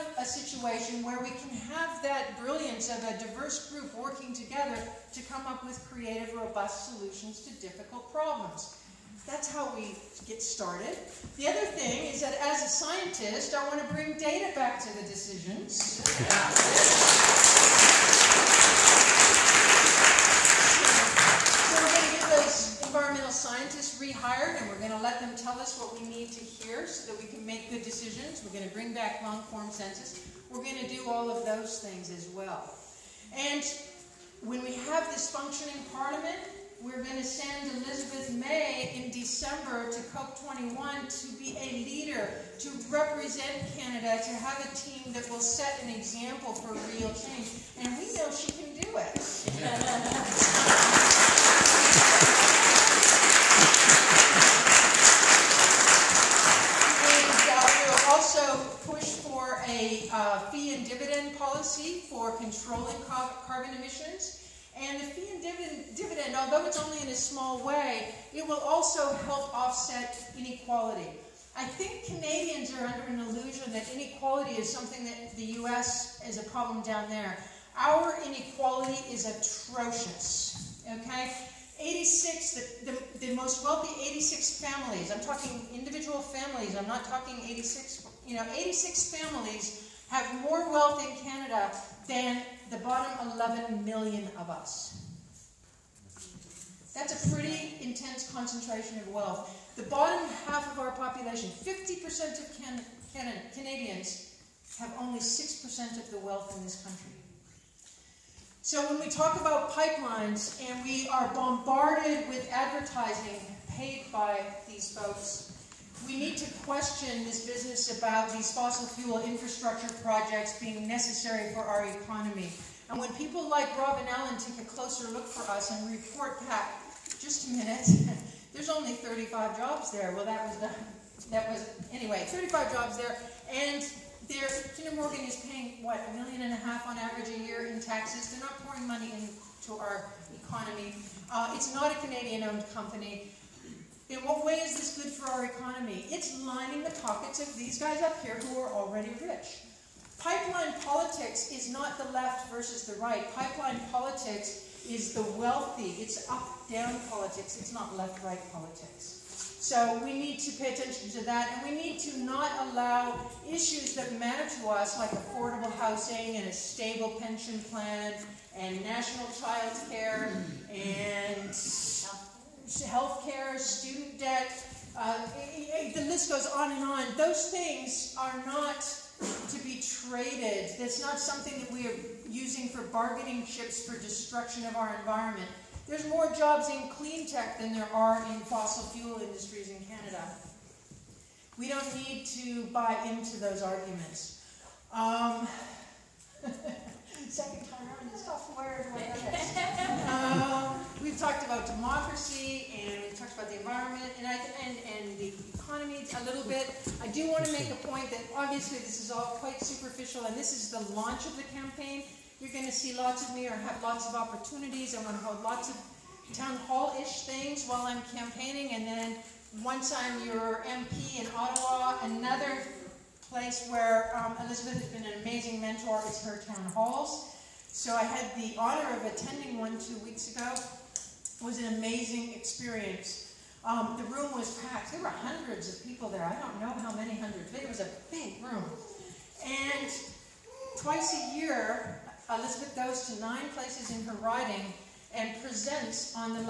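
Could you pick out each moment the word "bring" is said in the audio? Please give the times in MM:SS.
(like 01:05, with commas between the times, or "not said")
00:13, 00:28.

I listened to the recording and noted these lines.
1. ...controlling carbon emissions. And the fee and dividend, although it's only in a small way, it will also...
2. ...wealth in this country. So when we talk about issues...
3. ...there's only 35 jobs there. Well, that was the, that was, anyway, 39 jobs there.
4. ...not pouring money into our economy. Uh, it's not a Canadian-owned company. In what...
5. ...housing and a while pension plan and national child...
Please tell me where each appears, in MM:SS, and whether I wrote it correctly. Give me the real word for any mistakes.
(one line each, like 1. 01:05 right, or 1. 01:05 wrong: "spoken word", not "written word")
1. 01:02 right
2. 01:46 wrong: "pipelines", not "issues"
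3. 02:08 wrong: "35", not "39"
4. 02:18 right
5. 02:45 wrong: "stable", not "while".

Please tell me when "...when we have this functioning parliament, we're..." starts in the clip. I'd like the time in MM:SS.
00:34.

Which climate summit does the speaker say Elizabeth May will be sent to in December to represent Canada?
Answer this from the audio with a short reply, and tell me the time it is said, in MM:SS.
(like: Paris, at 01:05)
COP21, at 00:40.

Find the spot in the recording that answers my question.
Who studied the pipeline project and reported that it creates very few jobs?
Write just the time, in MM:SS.
02:03.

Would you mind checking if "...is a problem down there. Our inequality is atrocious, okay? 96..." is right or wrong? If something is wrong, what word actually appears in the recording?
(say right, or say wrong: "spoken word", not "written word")
wrong: "86", not "96".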